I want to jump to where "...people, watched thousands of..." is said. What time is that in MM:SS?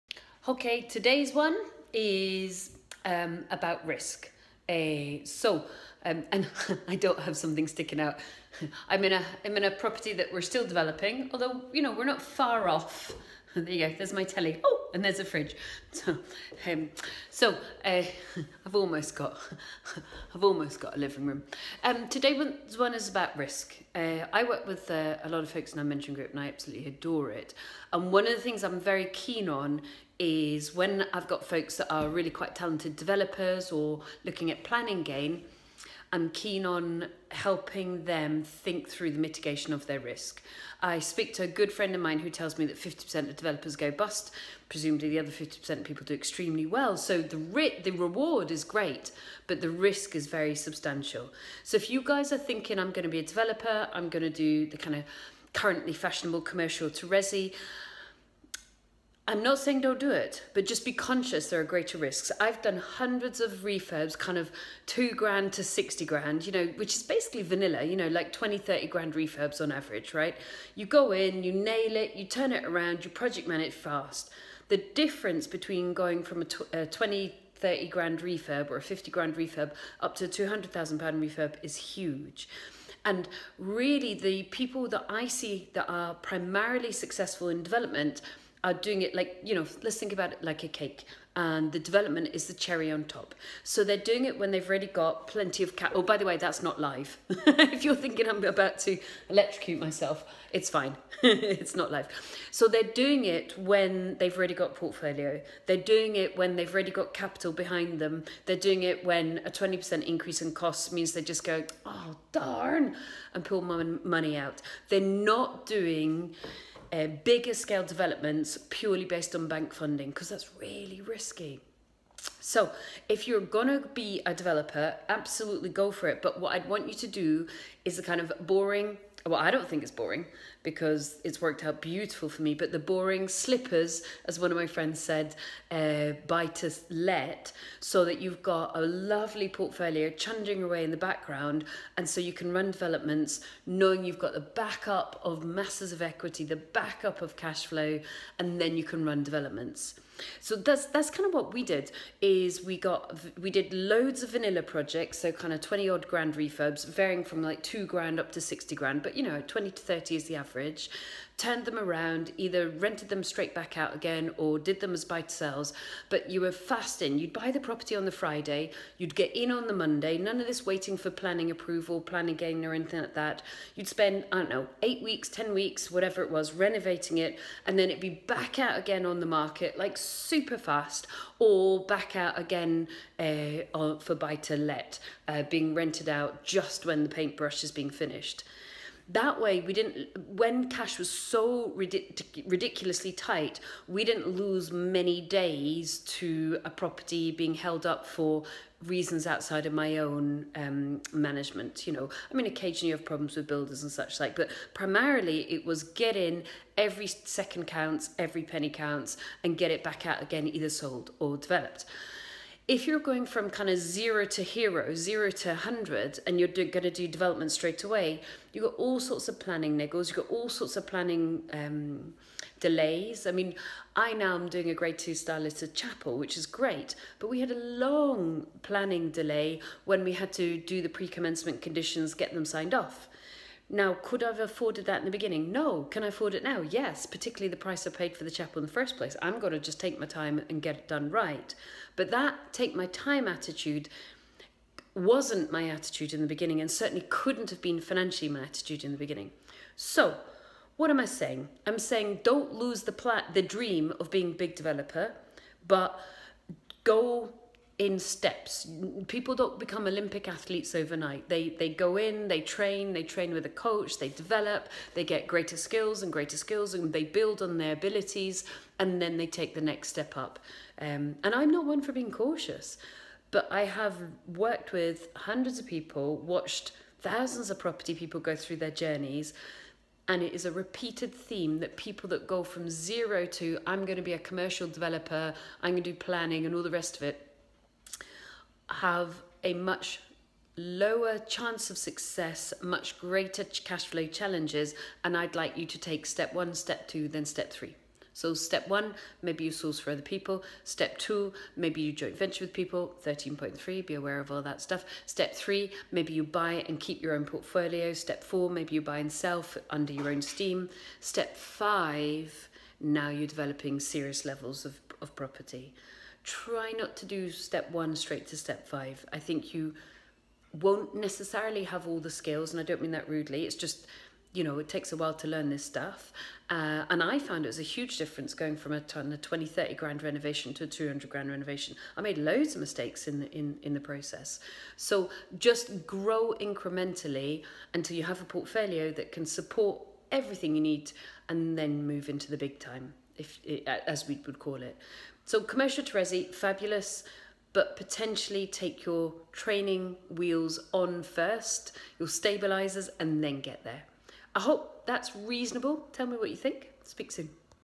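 04:35.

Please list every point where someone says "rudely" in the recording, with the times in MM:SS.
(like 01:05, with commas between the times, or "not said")
05:23.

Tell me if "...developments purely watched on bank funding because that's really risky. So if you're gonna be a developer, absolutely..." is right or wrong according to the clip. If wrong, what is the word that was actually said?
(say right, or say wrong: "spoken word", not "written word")
wrong: "based", not "watched".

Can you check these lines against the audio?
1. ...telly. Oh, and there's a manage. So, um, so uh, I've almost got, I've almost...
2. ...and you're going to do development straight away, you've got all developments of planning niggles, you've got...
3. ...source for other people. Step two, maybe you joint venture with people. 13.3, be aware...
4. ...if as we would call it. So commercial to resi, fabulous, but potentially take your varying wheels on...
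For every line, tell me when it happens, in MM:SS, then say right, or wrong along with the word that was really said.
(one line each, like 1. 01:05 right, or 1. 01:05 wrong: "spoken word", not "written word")
1. 00:14 wrong: "fridge", not "manage"
2. 03:36 wrong: "sorts", not "developments"
3. 04:59 right
4. 05:43 wrong: "training", not "varying".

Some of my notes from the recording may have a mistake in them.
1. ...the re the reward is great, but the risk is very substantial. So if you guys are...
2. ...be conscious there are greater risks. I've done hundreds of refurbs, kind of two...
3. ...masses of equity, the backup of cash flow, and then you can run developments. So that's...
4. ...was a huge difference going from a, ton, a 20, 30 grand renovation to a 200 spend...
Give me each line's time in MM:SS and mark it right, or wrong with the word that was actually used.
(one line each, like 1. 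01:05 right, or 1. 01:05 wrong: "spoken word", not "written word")
1. 00:47 right
2. 01:00 right
3. 02:25 right
4. 05:27 wrong: "grand", not "spend".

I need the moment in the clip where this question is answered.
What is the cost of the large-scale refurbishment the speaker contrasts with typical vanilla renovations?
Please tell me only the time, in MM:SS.
01:20.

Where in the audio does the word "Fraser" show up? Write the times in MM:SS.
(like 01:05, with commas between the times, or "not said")
not said.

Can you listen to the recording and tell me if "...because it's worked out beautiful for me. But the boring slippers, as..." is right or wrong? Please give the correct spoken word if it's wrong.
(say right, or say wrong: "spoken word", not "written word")
right.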